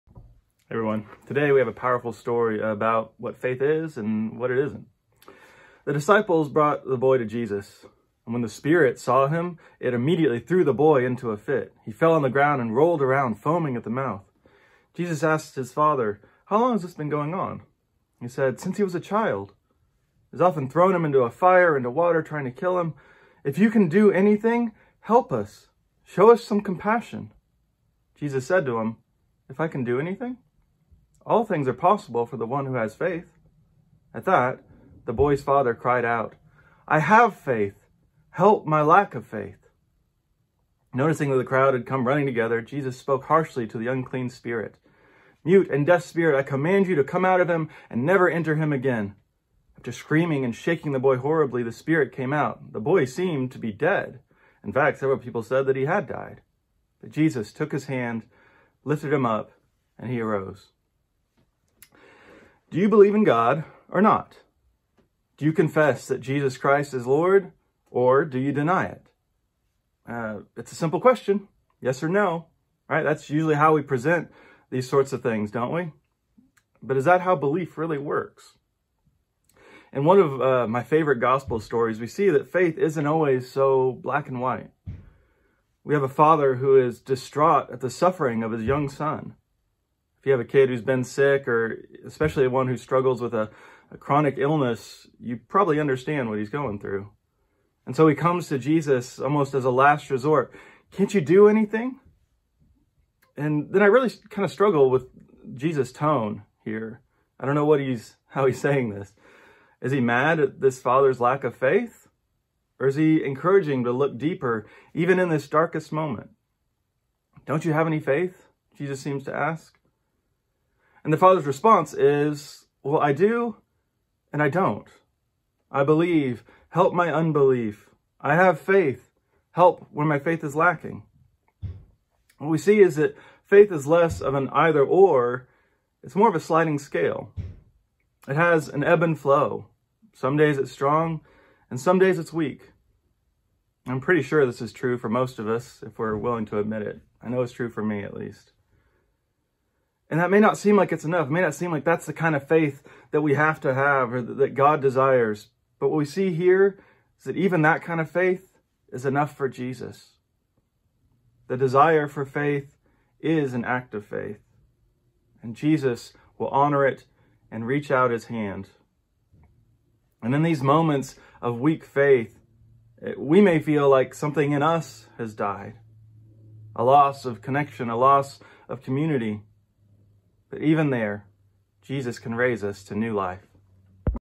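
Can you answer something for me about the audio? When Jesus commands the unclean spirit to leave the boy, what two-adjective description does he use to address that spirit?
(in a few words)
Mute and deaf spirit.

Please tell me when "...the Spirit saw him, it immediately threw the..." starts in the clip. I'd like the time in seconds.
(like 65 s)
8 s.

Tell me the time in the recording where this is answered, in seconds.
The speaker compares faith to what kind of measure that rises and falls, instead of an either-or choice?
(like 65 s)
136 s.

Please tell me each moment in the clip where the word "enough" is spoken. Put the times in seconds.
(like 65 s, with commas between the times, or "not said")
151 s, 159 s.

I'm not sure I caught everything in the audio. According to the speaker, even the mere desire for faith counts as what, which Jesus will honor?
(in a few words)
an act of faith.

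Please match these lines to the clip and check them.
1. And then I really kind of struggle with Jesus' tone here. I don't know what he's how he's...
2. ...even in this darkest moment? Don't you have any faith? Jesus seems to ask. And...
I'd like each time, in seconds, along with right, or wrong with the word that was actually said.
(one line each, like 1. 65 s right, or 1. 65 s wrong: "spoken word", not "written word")
1. 103 s right
2. 114 s right.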